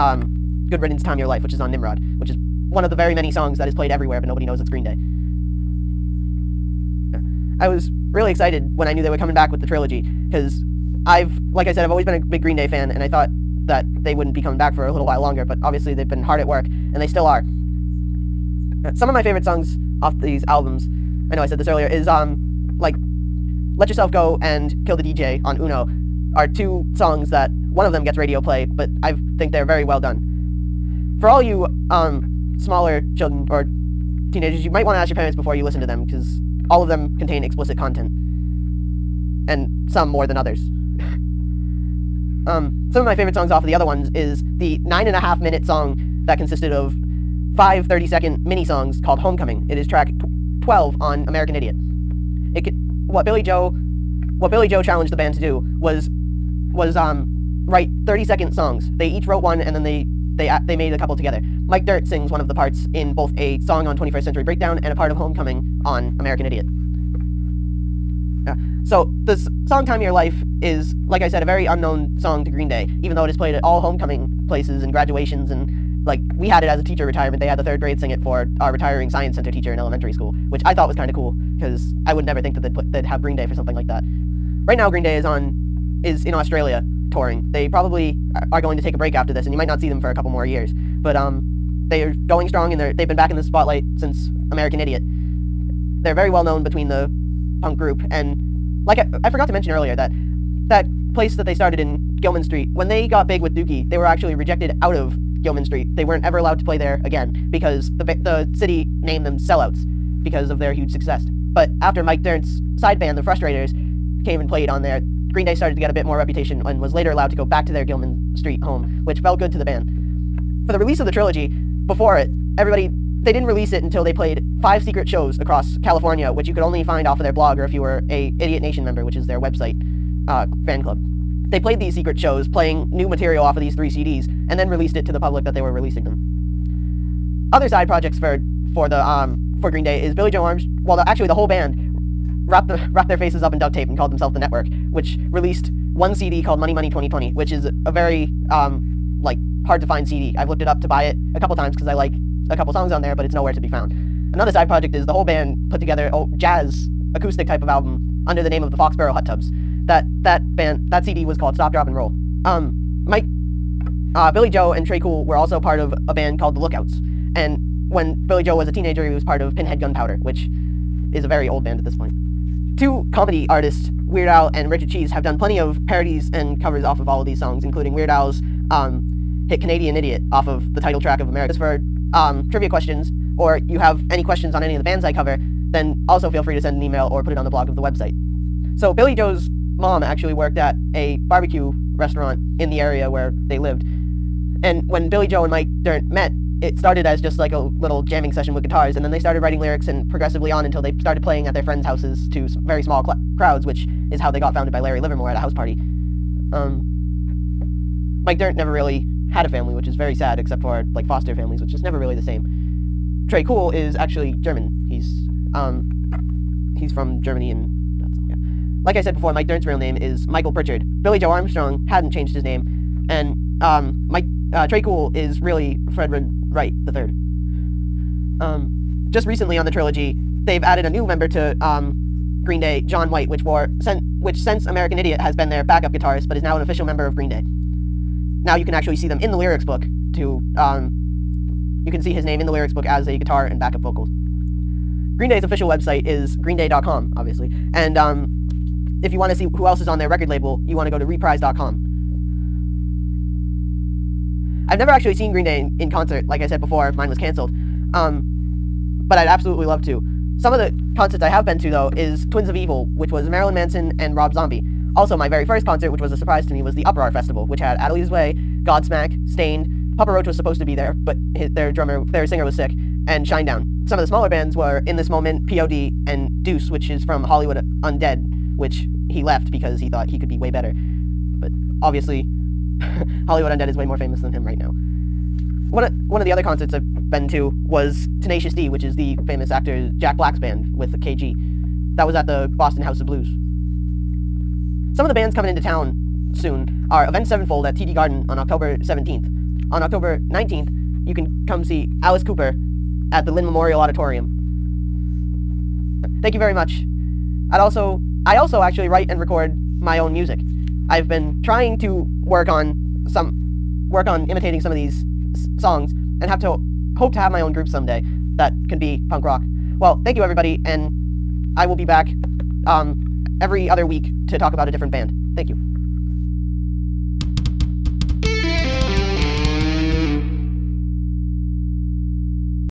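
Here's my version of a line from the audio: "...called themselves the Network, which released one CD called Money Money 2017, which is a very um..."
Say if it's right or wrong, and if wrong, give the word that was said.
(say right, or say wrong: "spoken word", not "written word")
wrong: "2020", not "2017".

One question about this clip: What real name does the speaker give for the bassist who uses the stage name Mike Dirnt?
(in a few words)
Michael Pritchard.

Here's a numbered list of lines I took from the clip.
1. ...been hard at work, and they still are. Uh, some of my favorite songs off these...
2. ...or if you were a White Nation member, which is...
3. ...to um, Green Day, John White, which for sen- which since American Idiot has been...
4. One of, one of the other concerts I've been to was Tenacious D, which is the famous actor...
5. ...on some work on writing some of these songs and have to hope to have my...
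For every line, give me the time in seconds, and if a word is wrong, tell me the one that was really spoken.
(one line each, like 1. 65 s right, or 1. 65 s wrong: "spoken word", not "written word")
1. 16 s right
2. 127 s wrong: "Idiot", not "White"
3. 231 s right
4. 285 s right
5. 312 s wrong: "imitating", not "writing".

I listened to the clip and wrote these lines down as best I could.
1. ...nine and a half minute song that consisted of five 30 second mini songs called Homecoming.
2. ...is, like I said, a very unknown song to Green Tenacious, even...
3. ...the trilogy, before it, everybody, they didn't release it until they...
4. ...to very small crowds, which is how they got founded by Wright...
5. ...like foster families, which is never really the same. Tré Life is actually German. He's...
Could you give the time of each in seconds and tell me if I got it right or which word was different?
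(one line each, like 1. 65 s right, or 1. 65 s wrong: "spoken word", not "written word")
1. 44 s right
2. 70 s wrong: "Day", not "Tenacious"
3. 121 s right
4. 202 s wrong: "Larry", not "Wright"
5. 210 s wrong: "Cool", not "Life".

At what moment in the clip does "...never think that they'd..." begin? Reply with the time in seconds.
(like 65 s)
82 s.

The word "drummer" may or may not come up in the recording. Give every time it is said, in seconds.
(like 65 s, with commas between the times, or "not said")
271 s.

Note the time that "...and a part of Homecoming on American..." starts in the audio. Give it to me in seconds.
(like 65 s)
64 s.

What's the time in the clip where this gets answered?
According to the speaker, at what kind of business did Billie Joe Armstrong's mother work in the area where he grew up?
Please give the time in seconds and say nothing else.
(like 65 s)
191 s.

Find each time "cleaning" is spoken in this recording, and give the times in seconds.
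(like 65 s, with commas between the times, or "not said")
not said.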